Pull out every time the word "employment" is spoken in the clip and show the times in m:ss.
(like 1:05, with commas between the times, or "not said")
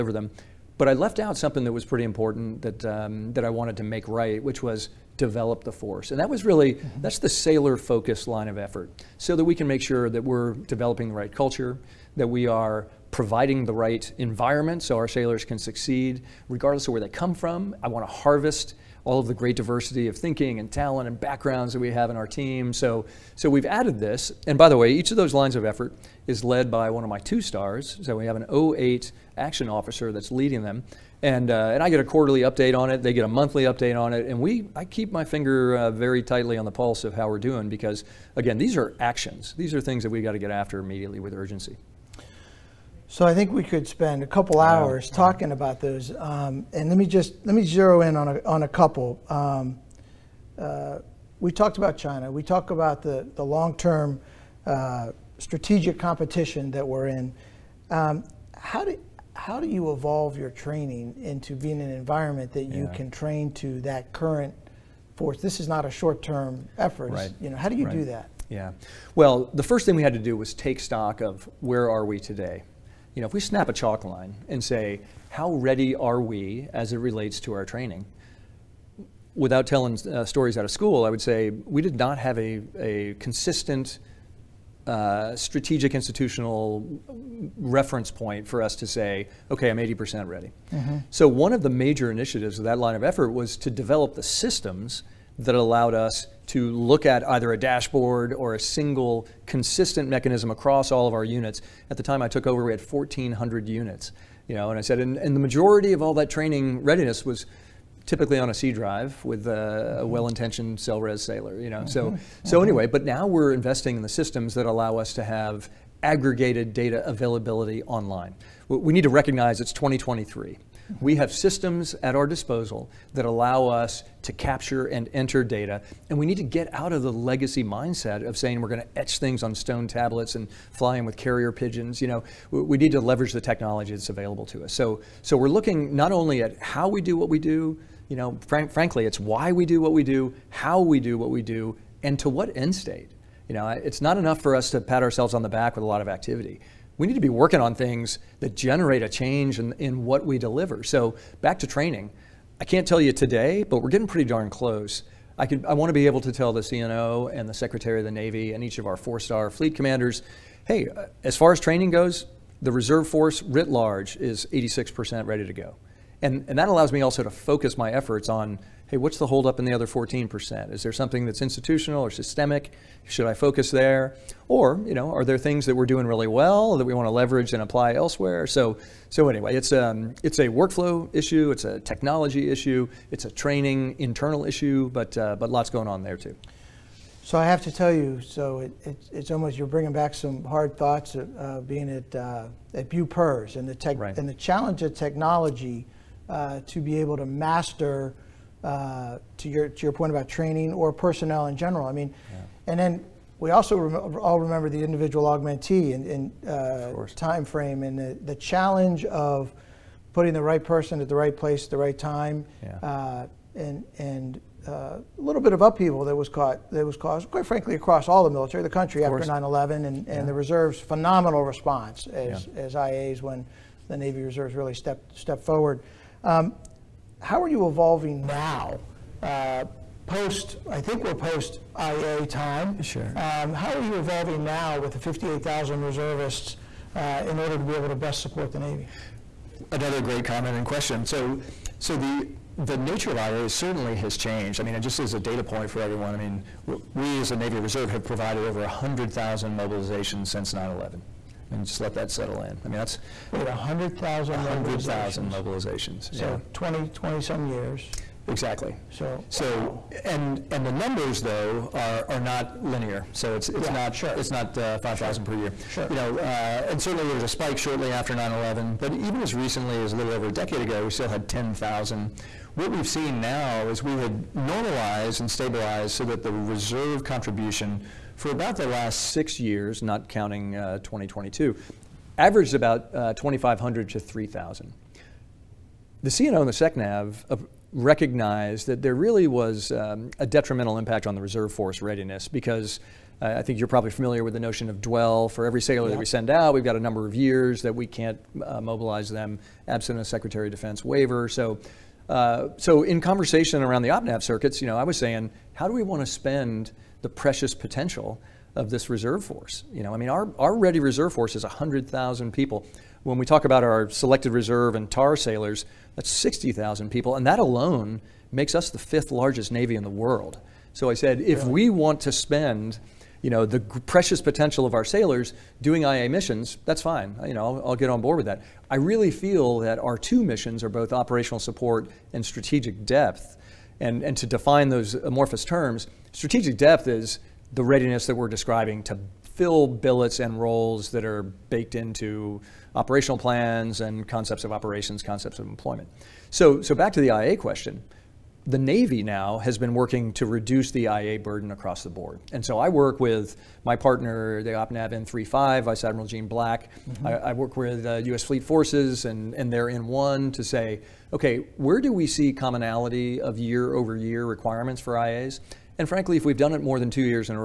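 5:45.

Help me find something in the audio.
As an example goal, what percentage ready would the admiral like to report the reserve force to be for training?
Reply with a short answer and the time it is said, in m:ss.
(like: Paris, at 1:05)
86%, at 2:44.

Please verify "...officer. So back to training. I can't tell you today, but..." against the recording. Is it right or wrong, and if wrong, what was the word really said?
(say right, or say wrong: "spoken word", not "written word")
wrong: "deliver", not "officer".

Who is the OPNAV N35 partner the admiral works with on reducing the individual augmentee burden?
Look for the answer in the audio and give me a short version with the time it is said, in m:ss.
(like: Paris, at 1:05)
Vice Admiral Gene Black, at 5:55.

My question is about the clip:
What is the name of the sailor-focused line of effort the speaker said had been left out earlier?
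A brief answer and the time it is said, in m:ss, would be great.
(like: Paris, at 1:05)
Develop the force, at 0:05.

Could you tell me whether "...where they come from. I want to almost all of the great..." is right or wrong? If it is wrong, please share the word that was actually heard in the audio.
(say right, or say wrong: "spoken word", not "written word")
wrong: "harvest", not "almost".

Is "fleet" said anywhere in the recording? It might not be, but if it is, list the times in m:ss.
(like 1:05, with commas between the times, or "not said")
2:39, 5:58.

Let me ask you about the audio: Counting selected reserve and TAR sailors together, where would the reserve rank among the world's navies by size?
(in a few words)
Fifth.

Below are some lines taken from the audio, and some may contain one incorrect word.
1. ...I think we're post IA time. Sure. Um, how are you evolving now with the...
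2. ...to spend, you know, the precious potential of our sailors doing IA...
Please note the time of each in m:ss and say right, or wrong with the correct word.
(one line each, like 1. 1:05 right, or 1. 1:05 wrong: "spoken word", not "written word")
1. 3:50 right
2. 5:22 right.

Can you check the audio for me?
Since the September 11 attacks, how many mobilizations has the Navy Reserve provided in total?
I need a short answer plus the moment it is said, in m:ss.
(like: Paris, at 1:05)
100,000, at 4:08.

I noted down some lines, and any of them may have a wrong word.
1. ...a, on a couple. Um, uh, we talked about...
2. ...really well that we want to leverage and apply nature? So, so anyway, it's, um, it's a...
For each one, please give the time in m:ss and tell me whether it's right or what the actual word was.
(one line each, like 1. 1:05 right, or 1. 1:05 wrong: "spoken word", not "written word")
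1. 0:48 right
2. 2:56 wrong: "elsewhere", not "nature".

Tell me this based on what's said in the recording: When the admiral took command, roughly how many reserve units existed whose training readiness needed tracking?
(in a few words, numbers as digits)
1,400.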